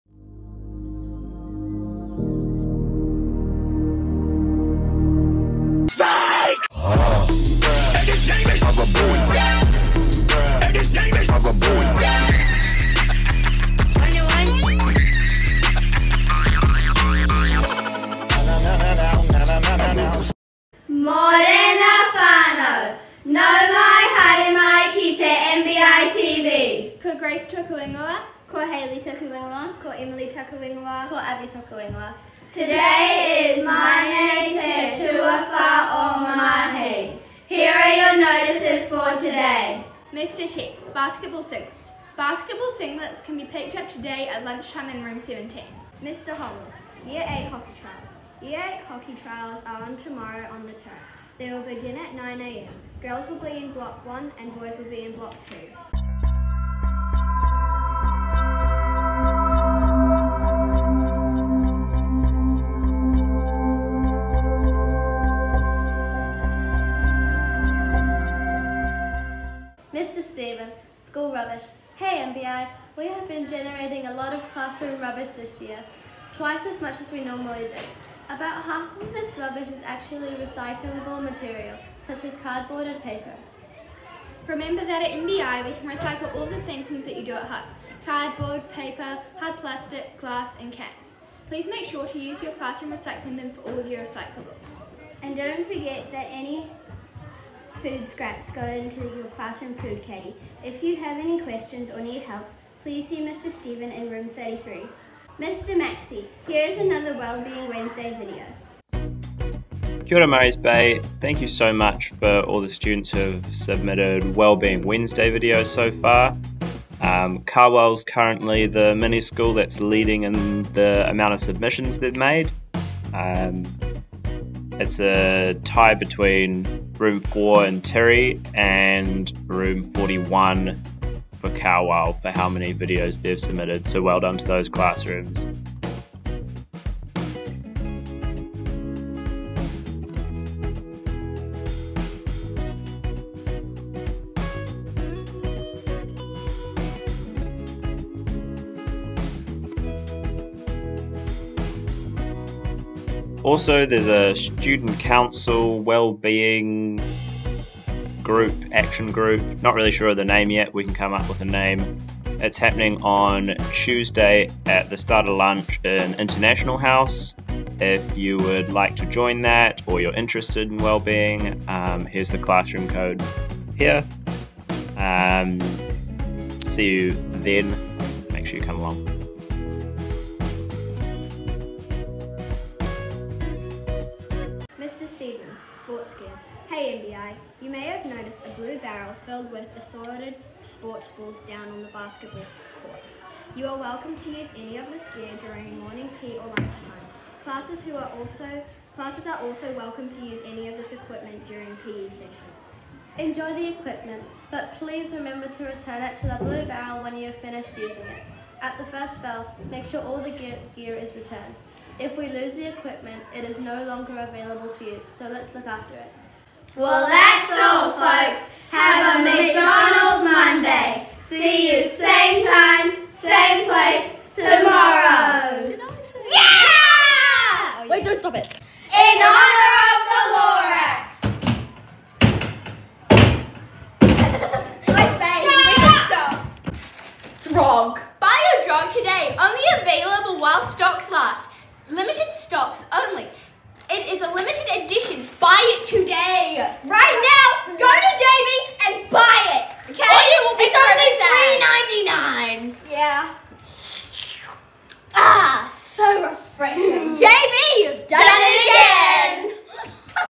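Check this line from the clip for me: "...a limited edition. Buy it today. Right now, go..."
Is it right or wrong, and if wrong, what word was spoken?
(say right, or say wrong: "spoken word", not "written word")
right.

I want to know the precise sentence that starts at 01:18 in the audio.
About half of this rubbish is actually recyclable material, such as cardboard and paper.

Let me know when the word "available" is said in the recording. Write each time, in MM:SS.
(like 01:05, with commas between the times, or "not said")
03:34, 03:59.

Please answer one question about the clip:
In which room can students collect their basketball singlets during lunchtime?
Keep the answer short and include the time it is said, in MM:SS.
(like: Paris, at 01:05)
Room 17, at 00:45.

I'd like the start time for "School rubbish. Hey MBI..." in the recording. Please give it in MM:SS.
01:11.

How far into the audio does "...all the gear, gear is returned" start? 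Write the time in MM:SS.
03:30.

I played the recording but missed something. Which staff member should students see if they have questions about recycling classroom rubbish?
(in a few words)
Mr. Stephen.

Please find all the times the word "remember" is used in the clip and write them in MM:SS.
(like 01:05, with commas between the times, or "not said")
01:24, 03:25.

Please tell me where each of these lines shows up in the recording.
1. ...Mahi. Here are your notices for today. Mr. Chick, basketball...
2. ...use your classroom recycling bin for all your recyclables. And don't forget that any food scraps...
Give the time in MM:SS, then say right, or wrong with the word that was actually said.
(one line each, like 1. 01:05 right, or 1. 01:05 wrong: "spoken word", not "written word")
1. 00:36 right
2. 01:32 right.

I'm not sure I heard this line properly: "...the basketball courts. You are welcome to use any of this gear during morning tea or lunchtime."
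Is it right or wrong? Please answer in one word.
right.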